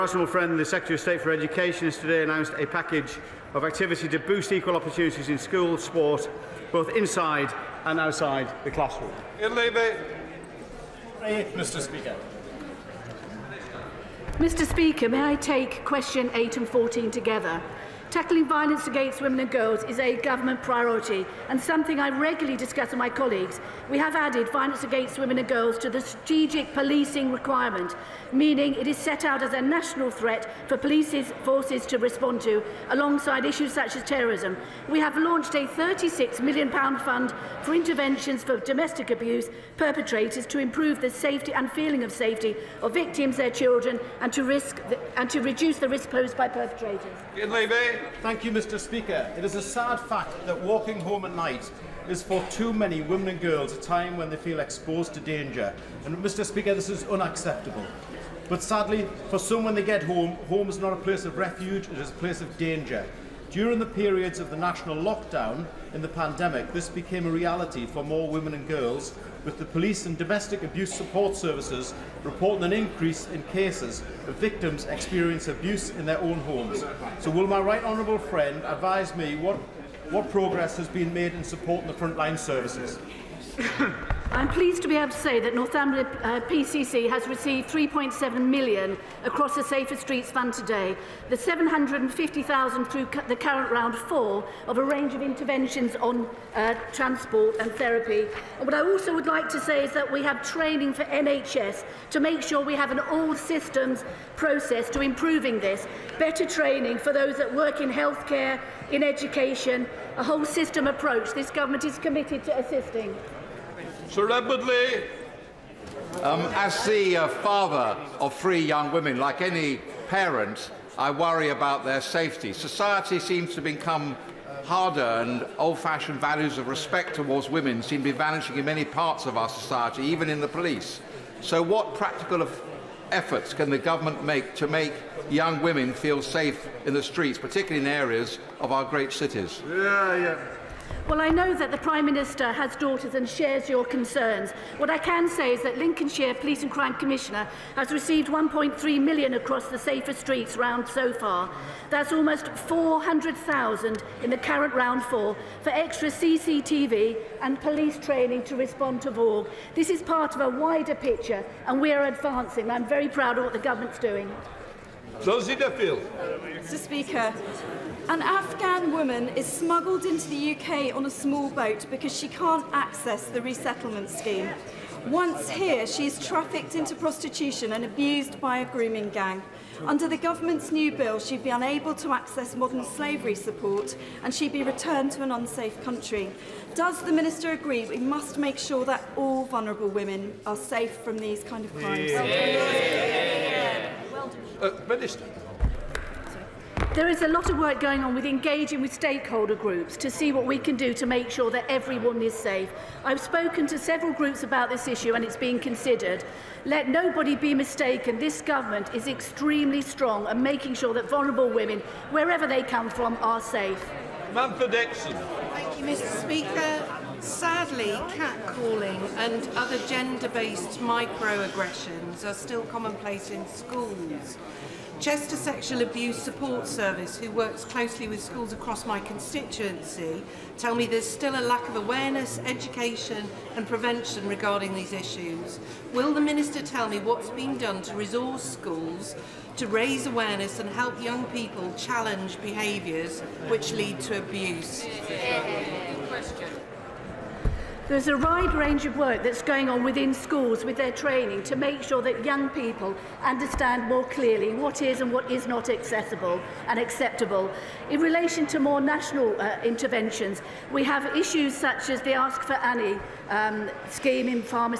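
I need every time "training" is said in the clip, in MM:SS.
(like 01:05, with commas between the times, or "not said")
01:40, 01:46, 02:37, 04:10.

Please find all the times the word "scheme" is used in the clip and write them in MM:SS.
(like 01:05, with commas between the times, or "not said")
02:54, 04:23.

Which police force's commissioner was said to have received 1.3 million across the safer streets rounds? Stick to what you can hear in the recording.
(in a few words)
Lincolnshire.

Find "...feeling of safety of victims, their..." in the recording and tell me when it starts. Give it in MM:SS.
00:41.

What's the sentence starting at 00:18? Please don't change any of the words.
Tackling violence against women and girls is a government priority and something I regularly discuss with my colleagues.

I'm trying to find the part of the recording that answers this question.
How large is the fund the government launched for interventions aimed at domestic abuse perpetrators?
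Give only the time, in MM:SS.
00:35.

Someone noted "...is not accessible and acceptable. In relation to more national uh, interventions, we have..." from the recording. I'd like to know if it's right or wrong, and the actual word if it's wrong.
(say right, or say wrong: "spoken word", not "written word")
right.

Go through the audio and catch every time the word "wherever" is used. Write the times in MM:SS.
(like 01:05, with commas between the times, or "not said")
03:32.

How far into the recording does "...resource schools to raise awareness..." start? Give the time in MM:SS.
03:57.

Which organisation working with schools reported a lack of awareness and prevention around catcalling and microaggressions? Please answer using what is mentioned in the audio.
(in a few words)
Chester Sexual Abuse Support Service.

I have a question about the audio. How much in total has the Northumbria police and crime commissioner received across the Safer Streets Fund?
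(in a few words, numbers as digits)
3.7 million.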